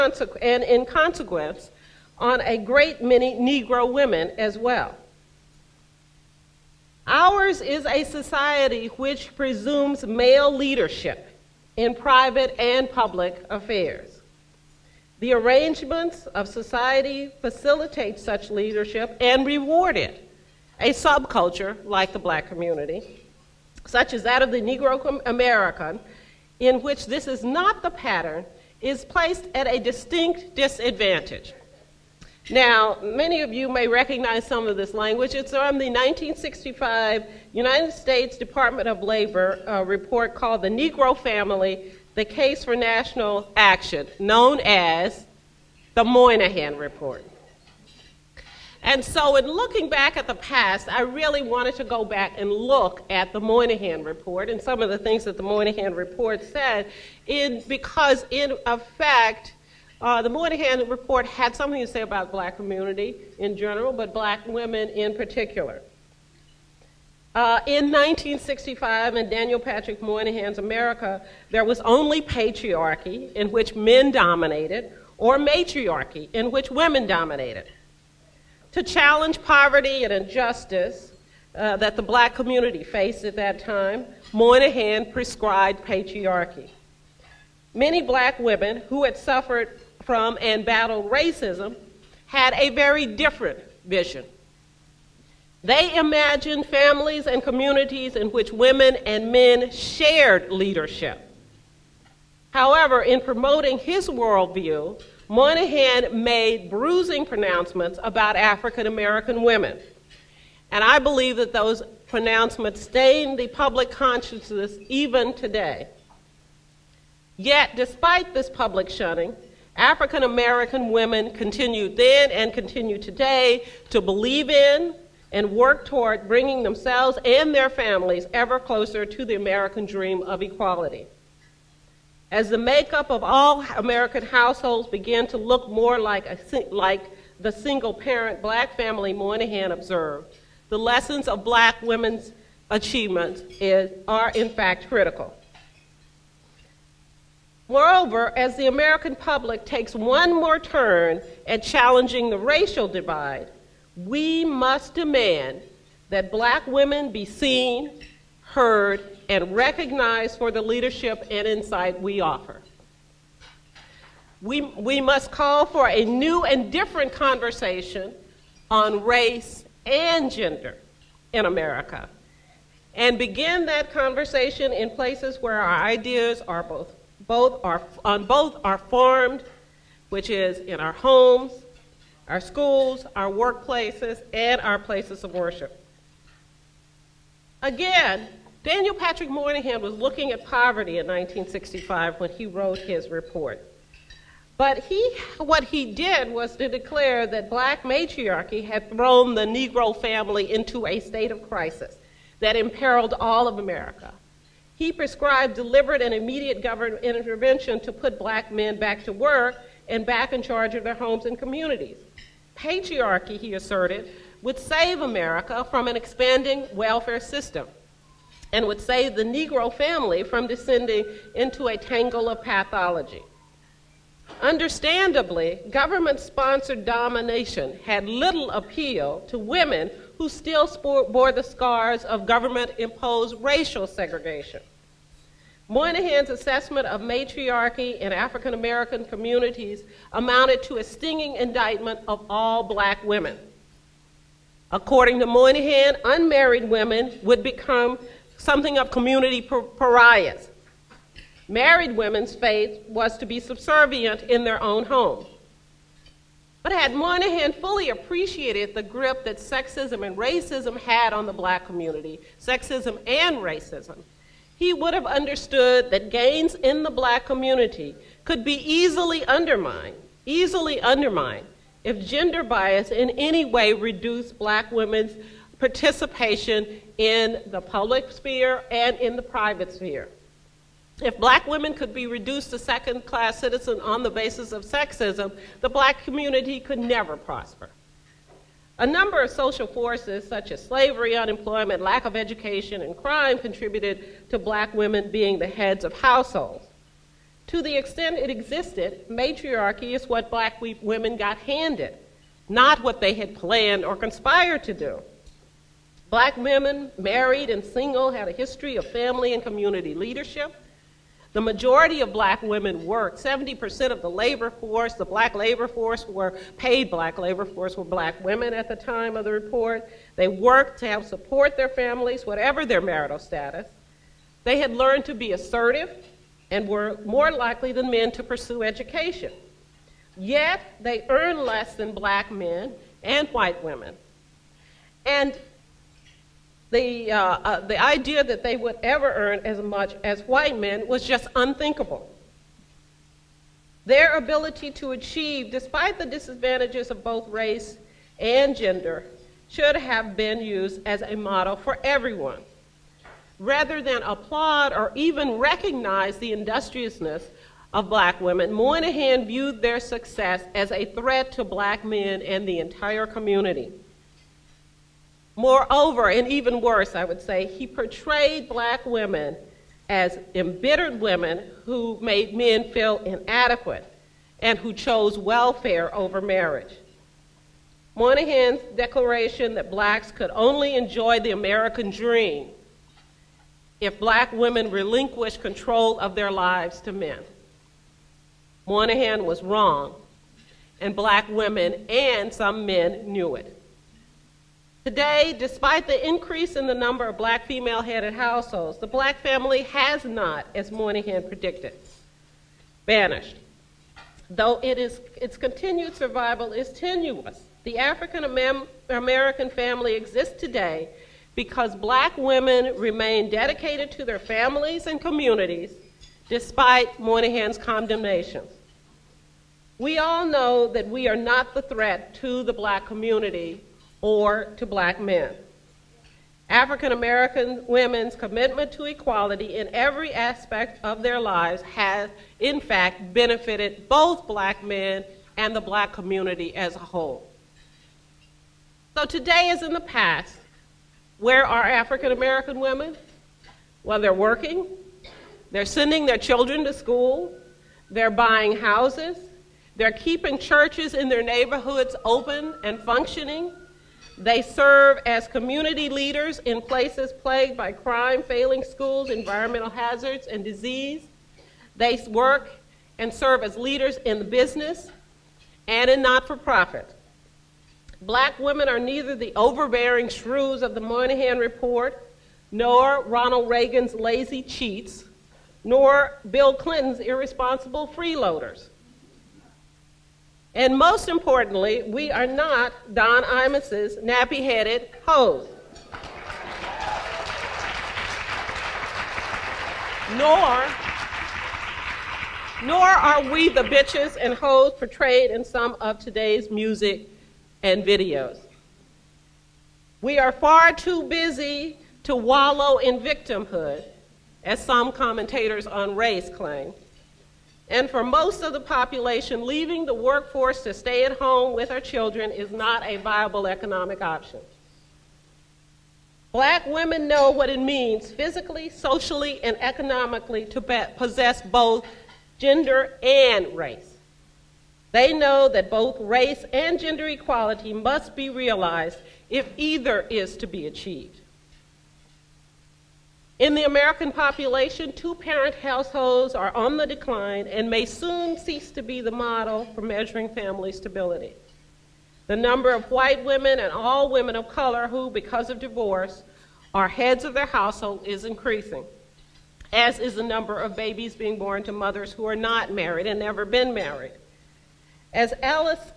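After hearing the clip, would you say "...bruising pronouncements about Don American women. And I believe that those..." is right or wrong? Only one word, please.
wrong.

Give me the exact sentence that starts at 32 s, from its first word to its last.
Now, many of you may recognize some of this language.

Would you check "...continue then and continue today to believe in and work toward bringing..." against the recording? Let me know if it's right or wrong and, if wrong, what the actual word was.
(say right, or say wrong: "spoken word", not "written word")
right.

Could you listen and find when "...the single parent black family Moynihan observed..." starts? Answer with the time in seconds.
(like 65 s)
137 s.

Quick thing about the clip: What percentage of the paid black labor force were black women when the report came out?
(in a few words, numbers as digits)
70%.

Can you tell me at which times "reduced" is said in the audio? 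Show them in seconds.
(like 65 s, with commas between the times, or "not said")
273 s, 282 s.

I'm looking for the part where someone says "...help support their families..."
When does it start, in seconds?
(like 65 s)
320 s.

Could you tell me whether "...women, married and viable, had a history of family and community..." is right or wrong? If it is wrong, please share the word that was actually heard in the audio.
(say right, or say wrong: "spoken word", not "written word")
wrong: "single", not "viable".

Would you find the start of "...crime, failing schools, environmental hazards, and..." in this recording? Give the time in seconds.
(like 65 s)
457 s.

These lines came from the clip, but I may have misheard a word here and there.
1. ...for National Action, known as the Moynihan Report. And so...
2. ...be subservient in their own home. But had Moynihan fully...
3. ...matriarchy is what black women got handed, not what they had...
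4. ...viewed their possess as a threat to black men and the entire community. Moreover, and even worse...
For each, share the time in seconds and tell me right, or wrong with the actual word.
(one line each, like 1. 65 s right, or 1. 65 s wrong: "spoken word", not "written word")
1. 42 s right
2. 253 s right
3. 299 s right
4. 359 s wrong: "success", not "possess".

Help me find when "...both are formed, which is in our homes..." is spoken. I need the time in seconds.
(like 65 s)
178 s.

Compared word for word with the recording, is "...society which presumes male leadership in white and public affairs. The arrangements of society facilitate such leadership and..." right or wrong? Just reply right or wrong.
wrong.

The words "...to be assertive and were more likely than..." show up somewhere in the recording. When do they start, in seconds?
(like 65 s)
325 s.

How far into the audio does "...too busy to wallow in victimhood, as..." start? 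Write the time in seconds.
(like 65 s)
500 s.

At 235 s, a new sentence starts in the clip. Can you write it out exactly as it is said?
Moynihan's assessment of matriarchy in African American communities amounted to a stinging indictment of all black women.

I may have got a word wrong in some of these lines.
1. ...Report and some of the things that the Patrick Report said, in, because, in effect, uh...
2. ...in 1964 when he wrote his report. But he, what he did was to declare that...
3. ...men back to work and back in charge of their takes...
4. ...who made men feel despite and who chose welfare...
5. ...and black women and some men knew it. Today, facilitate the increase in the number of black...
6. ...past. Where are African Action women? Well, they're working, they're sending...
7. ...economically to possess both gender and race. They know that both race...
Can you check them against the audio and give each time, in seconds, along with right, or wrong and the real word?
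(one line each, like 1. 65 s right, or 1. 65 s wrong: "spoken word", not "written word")
1. 54 s wrong: "Moynihan", not "Patrick"
2. 190 s wrong: "1965", not "1964"
3. 208 s wrong: "homes", not "takes"
4. 371 s wrong: "inadequate", not "despite"
5. 390 s wrong: "despite", not "facilitate"
6. 439 s wrong: "American", not "Action"
7. 519 s right.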